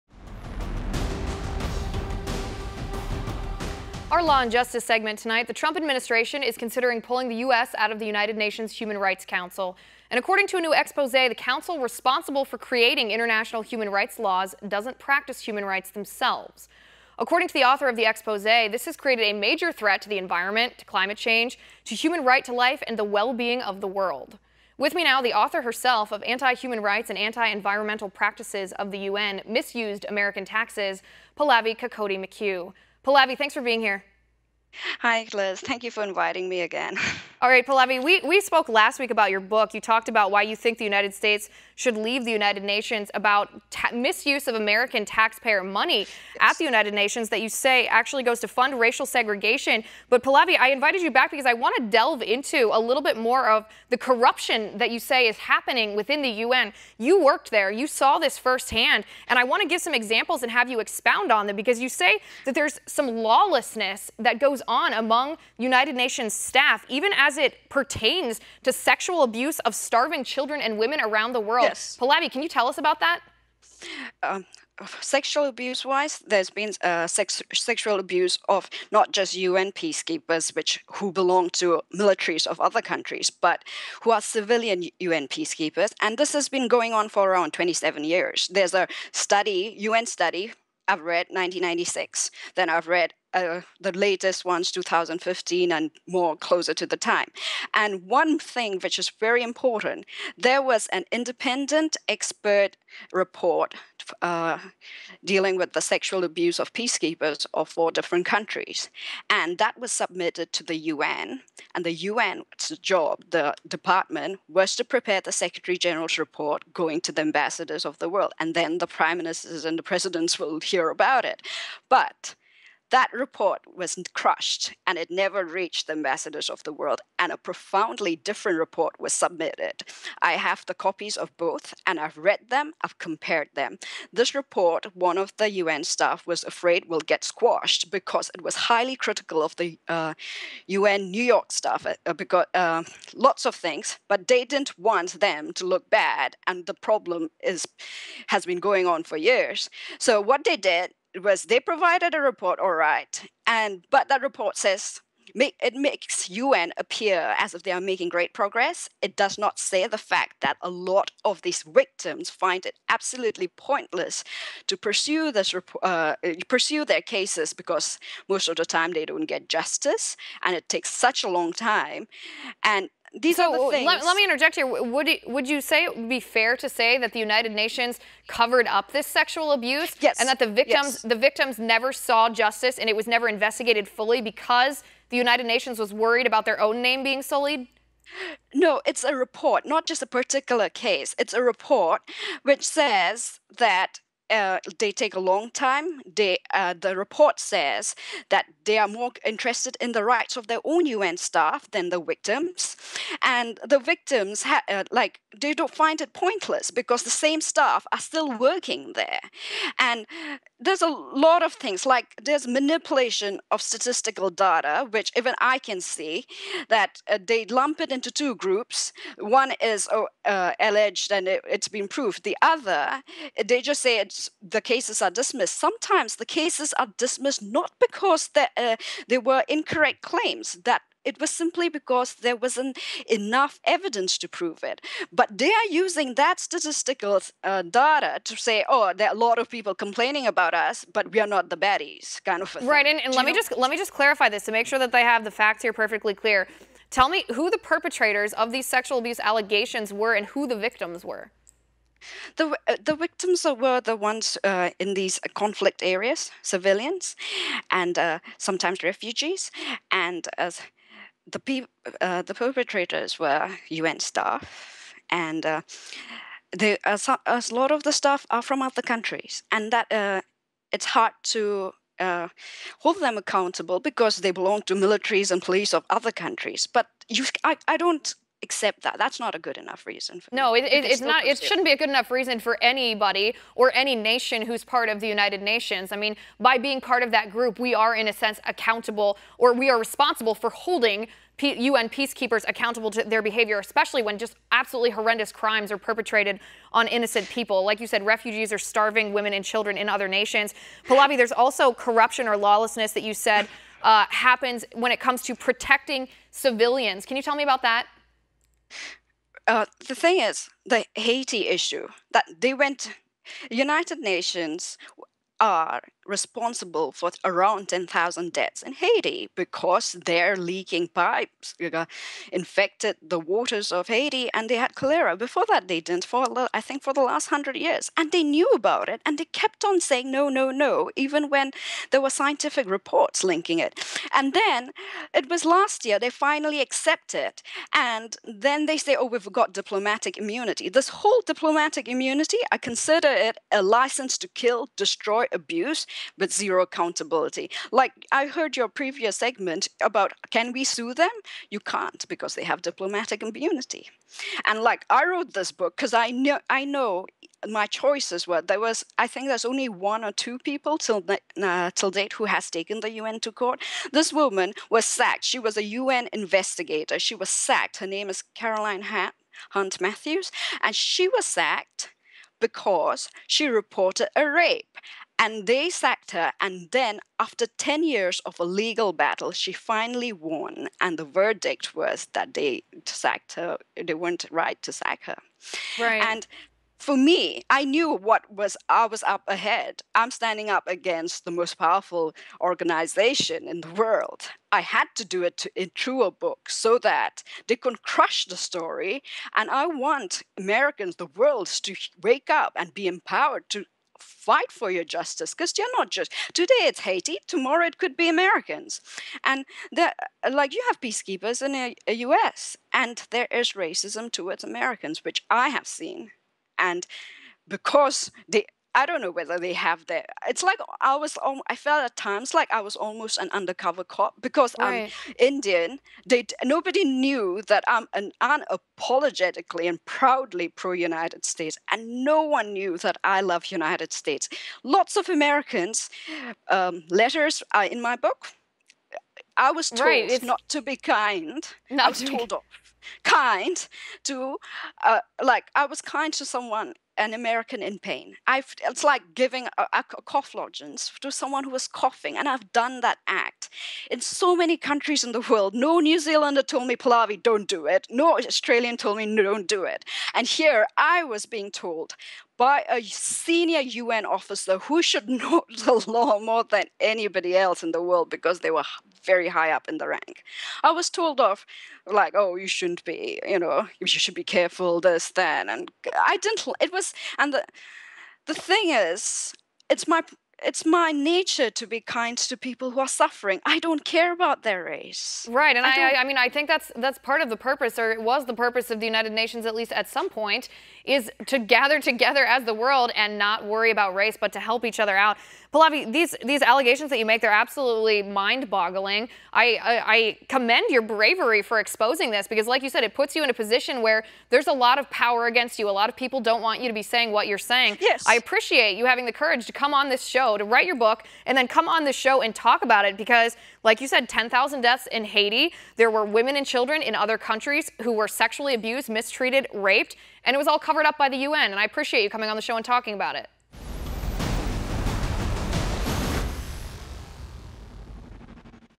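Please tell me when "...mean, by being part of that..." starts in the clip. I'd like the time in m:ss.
4:45.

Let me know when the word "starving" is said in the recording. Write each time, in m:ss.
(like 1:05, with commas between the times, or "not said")
1:09, 4:58.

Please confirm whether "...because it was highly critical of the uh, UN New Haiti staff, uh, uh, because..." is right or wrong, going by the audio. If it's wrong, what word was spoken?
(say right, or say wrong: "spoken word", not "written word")
wrong: "York", not "Haiti".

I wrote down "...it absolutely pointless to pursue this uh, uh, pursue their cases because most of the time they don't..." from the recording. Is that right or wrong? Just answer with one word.
right.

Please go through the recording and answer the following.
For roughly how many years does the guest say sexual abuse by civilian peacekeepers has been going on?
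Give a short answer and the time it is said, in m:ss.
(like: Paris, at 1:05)
27 years, at 1:27.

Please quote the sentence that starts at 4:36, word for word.
But you, I, I don't accept that.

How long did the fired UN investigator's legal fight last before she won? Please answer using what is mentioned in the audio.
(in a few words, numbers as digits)
10 years.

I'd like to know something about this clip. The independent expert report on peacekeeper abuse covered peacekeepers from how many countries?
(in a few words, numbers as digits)
4.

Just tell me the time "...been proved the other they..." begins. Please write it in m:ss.
3:41.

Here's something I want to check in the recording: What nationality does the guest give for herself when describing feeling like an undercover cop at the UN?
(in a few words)
Indian.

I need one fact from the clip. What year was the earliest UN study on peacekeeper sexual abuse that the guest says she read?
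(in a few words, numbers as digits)
1996.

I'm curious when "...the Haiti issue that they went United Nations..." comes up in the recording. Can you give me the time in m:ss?
5:10.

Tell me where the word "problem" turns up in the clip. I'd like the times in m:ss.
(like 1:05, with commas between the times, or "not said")
2:26.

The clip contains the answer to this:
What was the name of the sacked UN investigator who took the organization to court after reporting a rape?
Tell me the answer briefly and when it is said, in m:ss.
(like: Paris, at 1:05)
Caroline Hunt Matthews, at 6:08.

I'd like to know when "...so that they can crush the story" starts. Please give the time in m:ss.
6:36.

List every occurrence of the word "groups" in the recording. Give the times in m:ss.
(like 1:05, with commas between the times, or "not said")
3:38, 4:47.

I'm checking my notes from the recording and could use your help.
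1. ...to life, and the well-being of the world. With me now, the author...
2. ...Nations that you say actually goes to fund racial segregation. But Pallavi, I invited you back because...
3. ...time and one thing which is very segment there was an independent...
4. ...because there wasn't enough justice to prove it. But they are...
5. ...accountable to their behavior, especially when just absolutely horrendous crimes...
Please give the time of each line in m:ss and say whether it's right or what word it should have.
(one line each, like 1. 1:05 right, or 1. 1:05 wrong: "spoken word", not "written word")
1. 0:22 right
2. 0:46 right
3. 1:36 wrong: "important", not "segment"
4. 3:51 wrong: "evidence", not "justice"
5. 4:52 right.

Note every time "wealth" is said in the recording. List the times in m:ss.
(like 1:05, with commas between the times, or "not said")
not said.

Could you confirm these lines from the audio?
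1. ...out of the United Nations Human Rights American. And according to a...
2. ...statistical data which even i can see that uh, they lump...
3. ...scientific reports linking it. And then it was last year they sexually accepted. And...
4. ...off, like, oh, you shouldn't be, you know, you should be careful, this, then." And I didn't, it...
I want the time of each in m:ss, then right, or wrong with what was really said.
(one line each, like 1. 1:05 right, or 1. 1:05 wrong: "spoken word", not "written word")
1. 0:07 wrong: "Council", not "American"
2. 3:33 right
3. 5:32 wrong: "finally", not "sexually"
4. 7:51 right.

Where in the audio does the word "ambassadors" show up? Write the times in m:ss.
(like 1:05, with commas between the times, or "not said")
1:57, 2:05.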